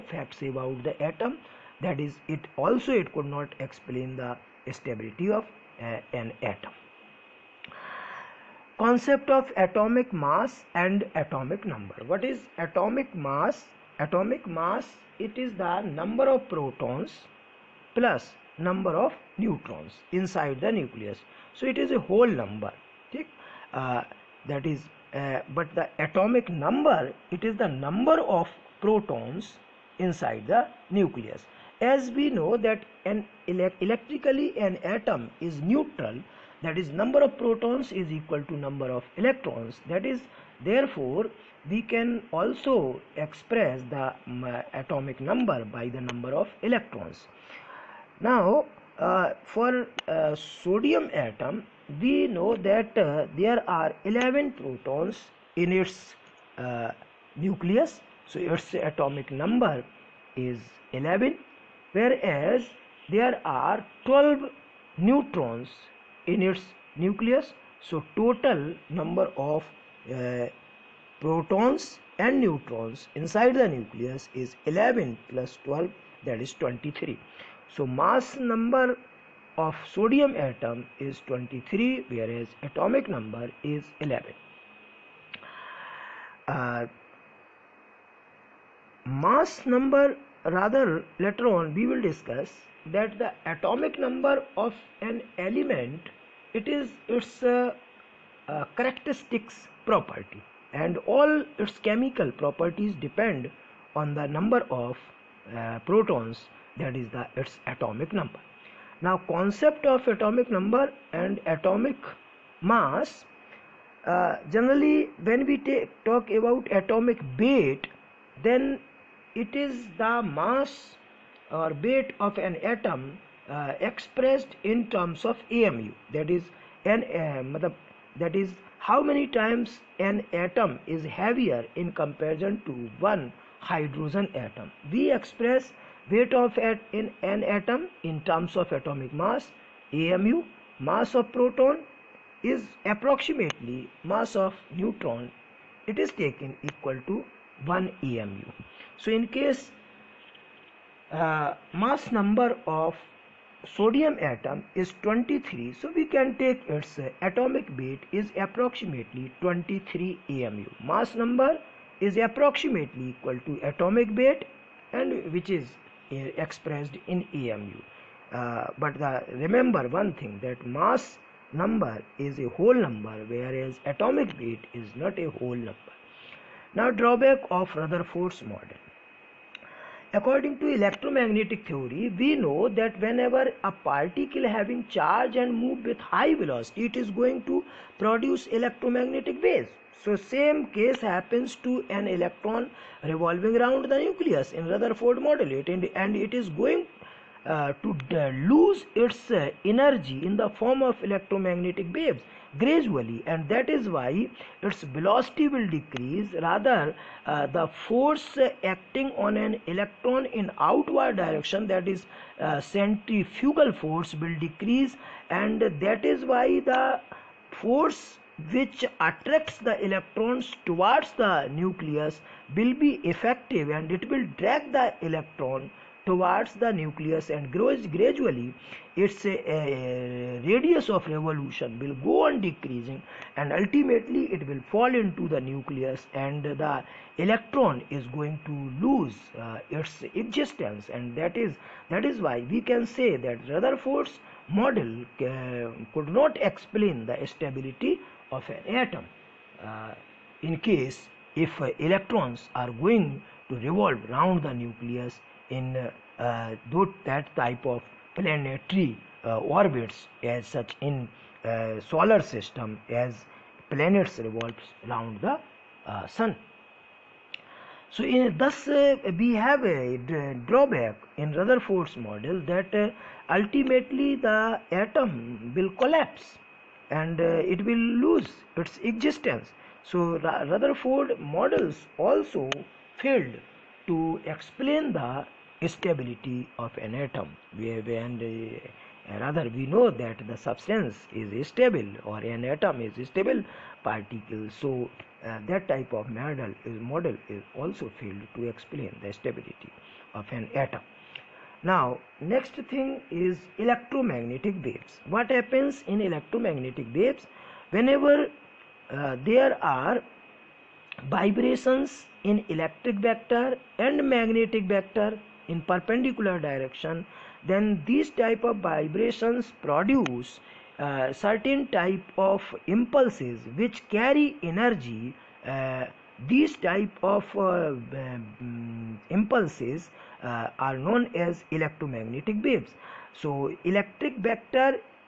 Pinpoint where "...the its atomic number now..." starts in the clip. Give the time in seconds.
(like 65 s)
107 s.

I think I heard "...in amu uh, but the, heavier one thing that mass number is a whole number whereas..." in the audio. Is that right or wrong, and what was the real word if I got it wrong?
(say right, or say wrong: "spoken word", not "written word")
wrong: "remember", not "heavier".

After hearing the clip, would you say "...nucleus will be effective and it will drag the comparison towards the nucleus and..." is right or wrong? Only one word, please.
wrong.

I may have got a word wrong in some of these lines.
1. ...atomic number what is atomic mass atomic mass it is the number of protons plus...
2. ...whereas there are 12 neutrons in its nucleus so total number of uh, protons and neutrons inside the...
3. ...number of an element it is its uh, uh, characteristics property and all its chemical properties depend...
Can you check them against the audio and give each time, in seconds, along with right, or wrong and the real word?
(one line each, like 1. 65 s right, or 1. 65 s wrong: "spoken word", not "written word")
1. 11 s right
2. 61 s right
3. 93 s right.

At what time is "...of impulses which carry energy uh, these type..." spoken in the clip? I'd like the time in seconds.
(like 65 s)
322 s.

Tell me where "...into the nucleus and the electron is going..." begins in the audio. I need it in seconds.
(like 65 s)
235 s.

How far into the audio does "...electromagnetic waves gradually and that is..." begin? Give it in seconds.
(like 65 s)
201 s.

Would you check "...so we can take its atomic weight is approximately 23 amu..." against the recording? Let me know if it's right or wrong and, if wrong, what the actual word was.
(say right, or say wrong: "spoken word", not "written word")
right.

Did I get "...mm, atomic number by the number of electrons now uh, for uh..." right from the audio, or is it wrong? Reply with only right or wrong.
right.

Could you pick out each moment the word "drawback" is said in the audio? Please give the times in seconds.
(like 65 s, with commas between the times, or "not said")
176 s, 270 s.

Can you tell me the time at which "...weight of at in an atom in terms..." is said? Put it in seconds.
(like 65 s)
136 s.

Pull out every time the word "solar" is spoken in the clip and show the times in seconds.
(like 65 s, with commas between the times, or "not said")
261 s.